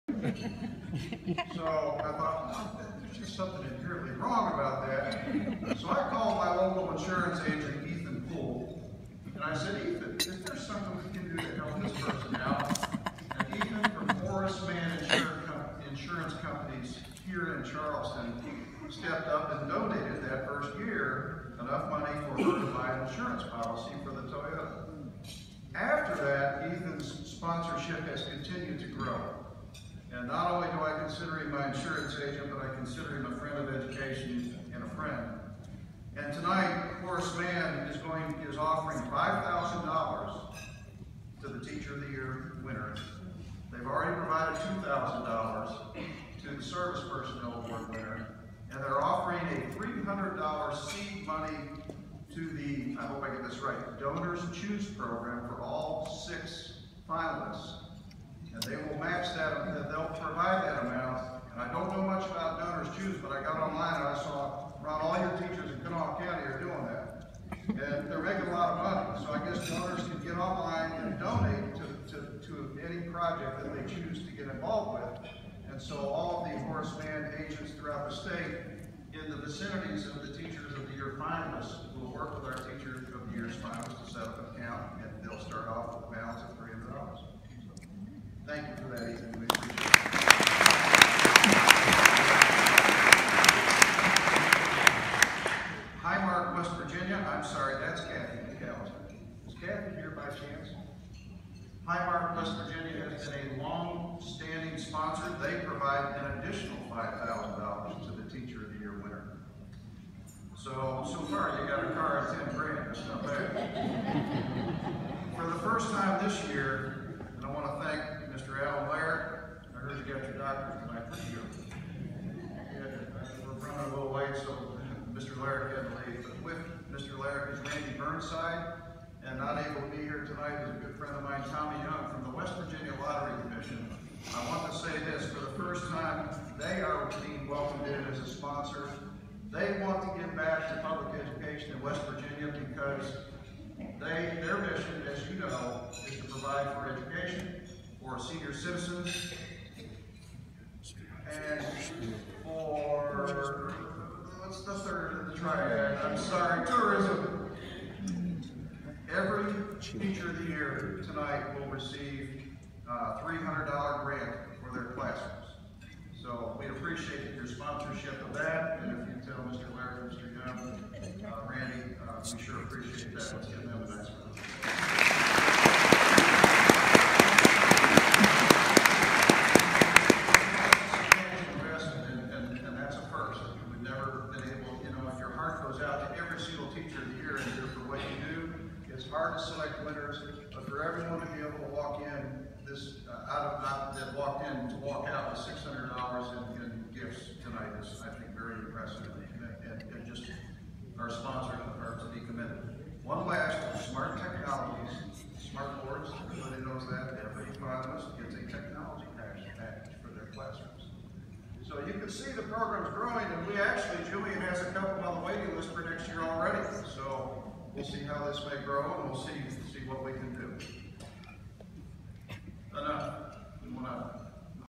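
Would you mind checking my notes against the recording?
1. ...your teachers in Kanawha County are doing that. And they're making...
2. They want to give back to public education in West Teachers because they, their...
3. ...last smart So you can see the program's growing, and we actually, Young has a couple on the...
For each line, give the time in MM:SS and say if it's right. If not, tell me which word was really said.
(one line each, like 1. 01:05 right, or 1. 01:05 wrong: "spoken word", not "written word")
1. 01:05 right
2. 02:19 wrong: "Virginia", not "Teachers"
3. 03:23 wrong: "Julian", not "Young".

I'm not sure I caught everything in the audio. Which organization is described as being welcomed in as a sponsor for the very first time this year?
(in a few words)
West Virginia Lottery Commission.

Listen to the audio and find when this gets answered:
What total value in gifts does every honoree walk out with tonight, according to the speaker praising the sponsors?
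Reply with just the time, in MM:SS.
03:15.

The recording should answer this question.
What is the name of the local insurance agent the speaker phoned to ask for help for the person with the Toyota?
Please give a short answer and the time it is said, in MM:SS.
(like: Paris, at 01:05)
Ethan Poole, at 00:07.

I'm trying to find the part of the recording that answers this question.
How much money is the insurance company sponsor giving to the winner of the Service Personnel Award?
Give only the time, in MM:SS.
00:44.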